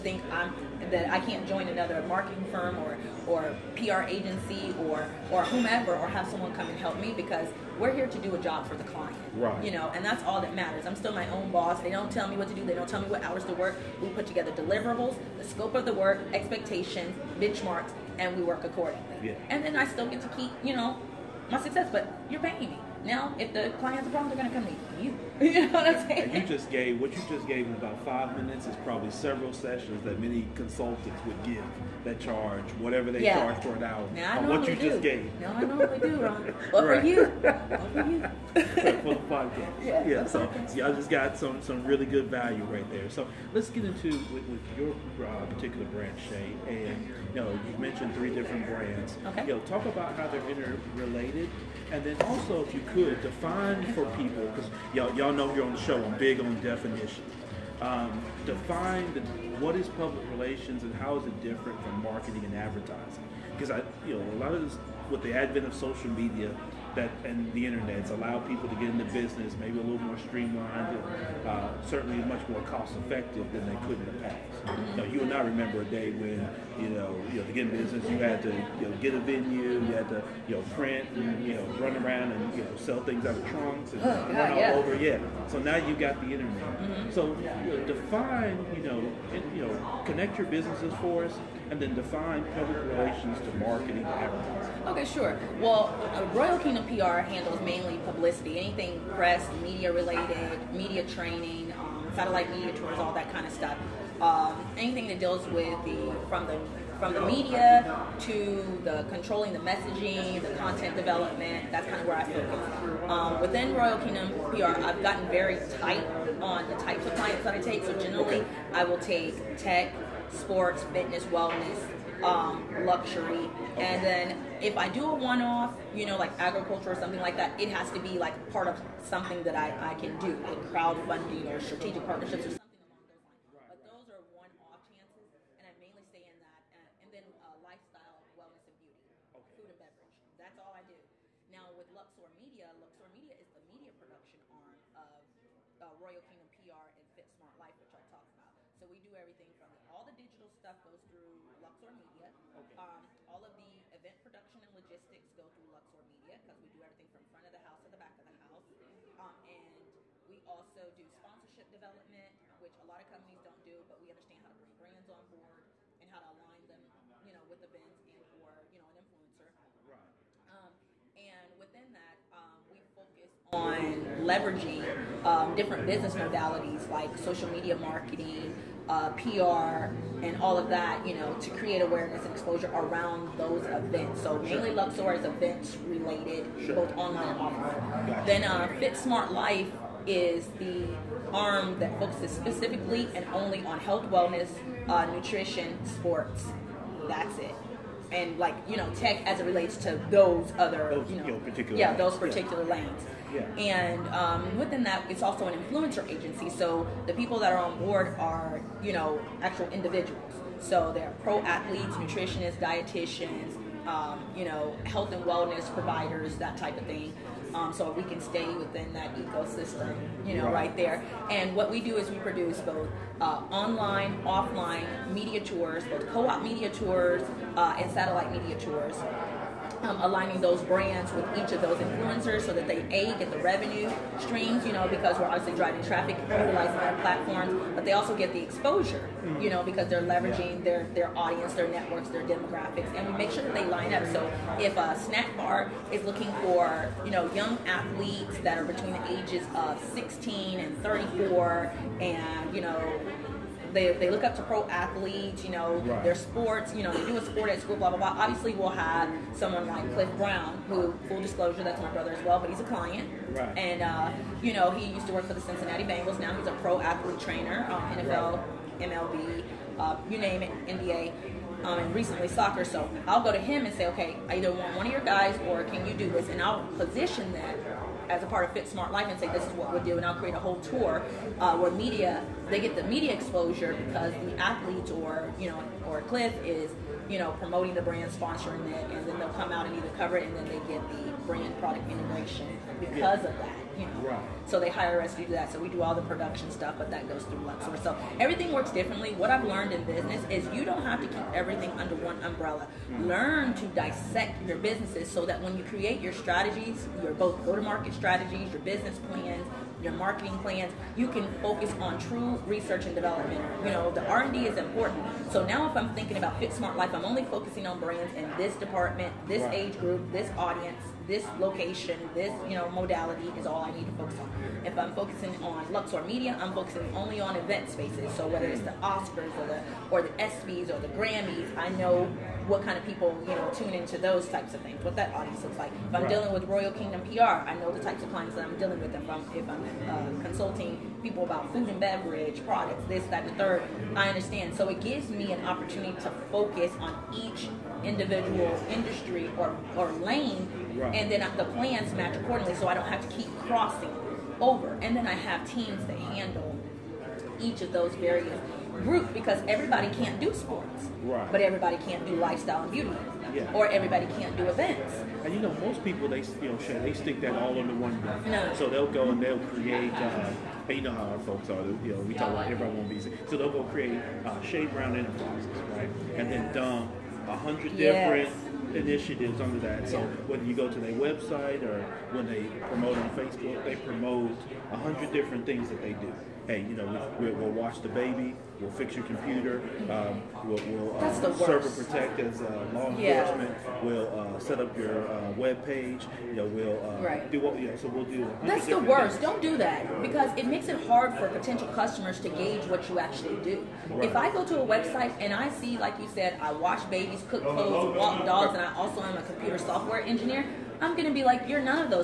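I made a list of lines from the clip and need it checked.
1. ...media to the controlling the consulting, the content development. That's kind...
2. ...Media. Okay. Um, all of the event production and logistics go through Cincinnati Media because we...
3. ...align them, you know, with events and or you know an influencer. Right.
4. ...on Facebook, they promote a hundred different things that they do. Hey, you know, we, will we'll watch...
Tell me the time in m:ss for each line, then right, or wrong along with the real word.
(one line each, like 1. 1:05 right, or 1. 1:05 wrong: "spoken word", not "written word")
1. 1:47 wrong: "messaging", not "consulting"
2. 2:31 wrong: "Luxor", not "Cincinnati"
3. 2:46 right
4. 6:22 right.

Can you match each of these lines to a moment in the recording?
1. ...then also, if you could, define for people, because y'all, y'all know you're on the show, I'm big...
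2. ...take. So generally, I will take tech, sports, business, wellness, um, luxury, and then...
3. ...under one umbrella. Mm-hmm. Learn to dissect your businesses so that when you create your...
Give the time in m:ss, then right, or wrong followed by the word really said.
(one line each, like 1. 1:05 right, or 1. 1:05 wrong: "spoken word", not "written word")
1. 0:52 right
2. 1:57 wrong: "fitness", not "business"
3. 5:01 right.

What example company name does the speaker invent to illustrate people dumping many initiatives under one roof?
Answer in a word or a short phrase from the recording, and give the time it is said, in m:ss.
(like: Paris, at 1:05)
Shay Brown Enterprises, at 6:14.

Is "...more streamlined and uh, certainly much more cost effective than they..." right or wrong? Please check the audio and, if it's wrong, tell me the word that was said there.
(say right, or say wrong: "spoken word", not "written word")
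right.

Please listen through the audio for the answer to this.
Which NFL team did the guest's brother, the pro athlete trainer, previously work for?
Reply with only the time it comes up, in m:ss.
4:25.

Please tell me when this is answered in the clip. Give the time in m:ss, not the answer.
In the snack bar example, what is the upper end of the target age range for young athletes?
4:10.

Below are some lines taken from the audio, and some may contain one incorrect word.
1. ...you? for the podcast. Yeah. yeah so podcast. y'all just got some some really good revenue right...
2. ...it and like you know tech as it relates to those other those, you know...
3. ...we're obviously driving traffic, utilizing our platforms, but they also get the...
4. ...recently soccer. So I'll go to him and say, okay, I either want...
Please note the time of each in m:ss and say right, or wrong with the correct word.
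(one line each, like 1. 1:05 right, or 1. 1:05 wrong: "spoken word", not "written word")
1. 0:38 wrong: "value", not "revenue"
2. 3:17 right
3. 3:55 right
4. 4:31 right.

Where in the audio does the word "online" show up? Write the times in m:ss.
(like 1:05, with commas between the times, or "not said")
3:06, 3:43.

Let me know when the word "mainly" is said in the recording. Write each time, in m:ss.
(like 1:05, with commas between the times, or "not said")
1:37, 2:15, 3:04.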